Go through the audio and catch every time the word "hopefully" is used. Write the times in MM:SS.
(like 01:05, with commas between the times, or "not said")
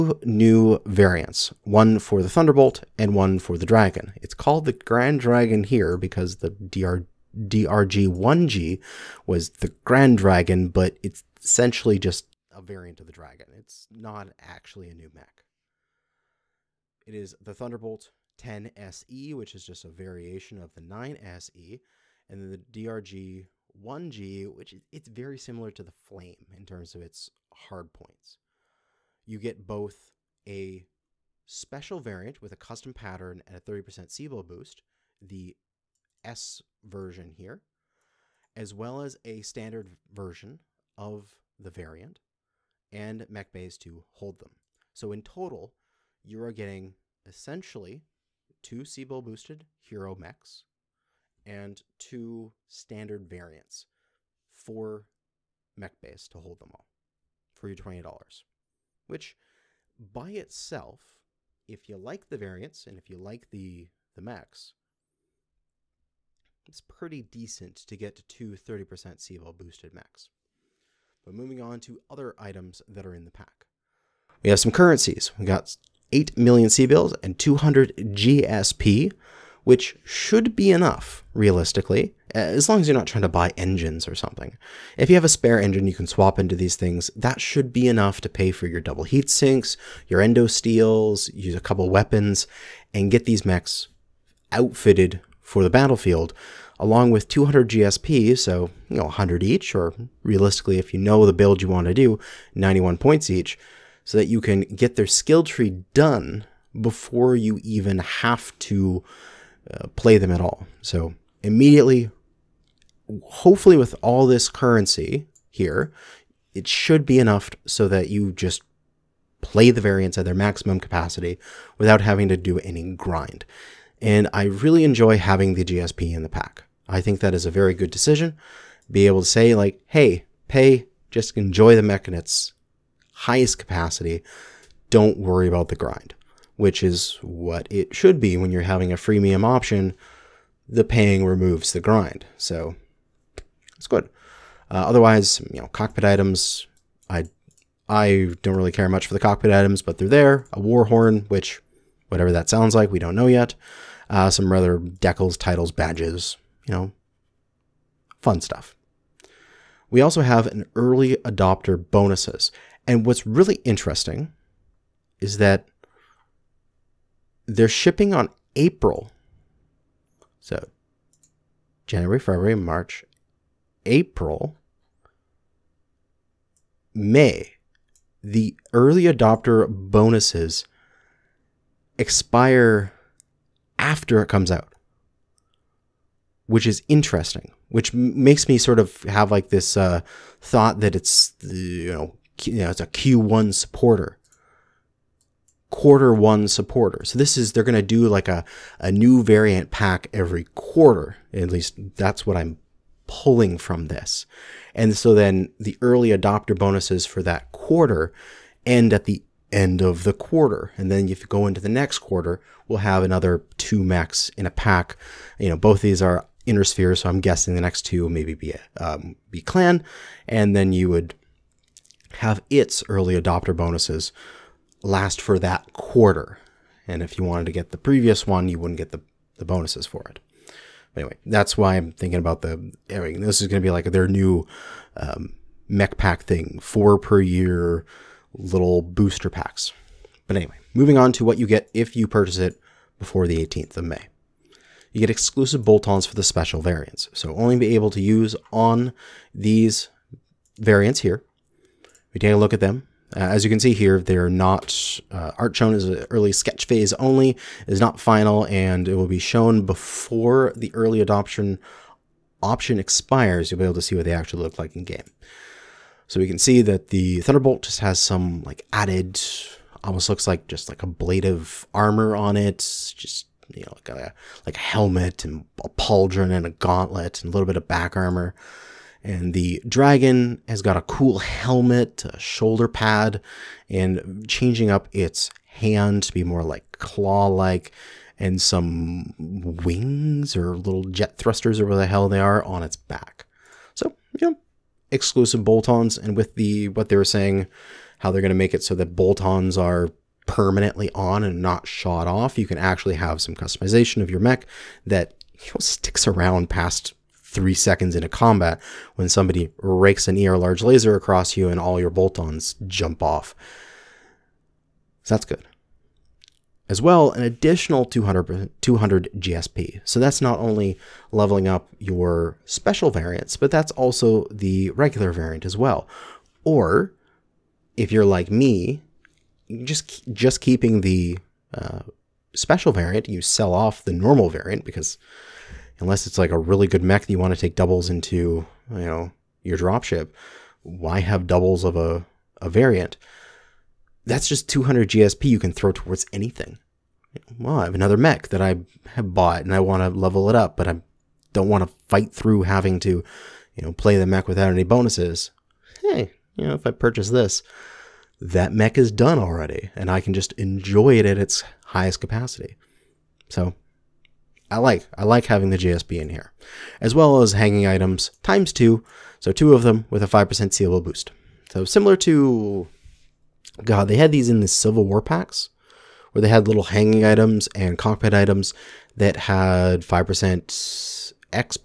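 01:53.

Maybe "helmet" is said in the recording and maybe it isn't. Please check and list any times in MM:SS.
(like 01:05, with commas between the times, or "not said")
04:34, 04:41.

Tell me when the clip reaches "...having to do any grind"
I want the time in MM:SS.
02:02.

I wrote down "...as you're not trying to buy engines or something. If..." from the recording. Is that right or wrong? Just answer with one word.
right.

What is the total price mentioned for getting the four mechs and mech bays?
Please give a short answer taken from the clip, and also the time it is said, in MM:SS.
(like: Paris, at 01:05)
$20, at 00:57.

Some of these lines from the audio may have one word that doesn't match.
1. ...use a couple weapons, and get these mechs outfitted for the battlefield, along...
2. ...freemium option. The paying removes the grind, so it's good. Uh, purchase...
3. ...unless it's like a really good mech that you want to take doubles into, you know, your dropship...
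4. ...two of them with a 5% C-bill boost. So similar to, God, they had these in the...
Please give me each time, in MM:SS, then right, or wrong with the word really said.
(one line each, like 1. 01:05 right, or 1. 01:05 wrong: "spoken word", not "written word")
1. 01:31 right
2. 02:18 wrong: "otherwise", not "purchase"
3. 05:35 right
4. 06:09 right.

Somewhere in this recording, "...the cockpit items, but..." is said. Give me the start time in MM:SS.
02:29.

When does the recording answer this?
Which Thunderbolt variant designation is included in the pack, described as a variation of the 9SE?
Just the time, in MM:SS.
00:17.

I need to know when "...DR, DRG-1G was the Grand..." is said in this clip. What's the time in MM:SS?
00:06.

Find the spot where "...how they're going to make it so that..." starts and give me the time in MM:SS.
04:57.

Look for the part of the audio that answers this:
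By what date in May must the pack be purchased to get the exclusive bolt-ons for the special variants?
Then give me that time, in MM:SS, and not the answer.
04:03.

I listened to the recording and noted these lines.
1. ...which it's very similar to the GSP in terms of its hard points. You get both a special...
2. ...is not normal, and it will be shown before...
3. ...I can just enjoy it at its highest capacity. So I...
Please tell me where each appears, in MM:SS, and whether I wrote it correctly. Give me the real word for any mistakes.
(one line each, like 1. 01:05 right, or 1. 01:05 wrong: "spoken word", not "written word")
1. 00:24 wrong: "Flame", not "GSP"
2. 04:17 wrong: "final", not "normal"
3. 05:59 right.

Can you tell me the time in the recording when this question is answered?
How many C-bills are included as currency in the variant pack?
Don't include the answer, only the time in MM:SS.
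01:16.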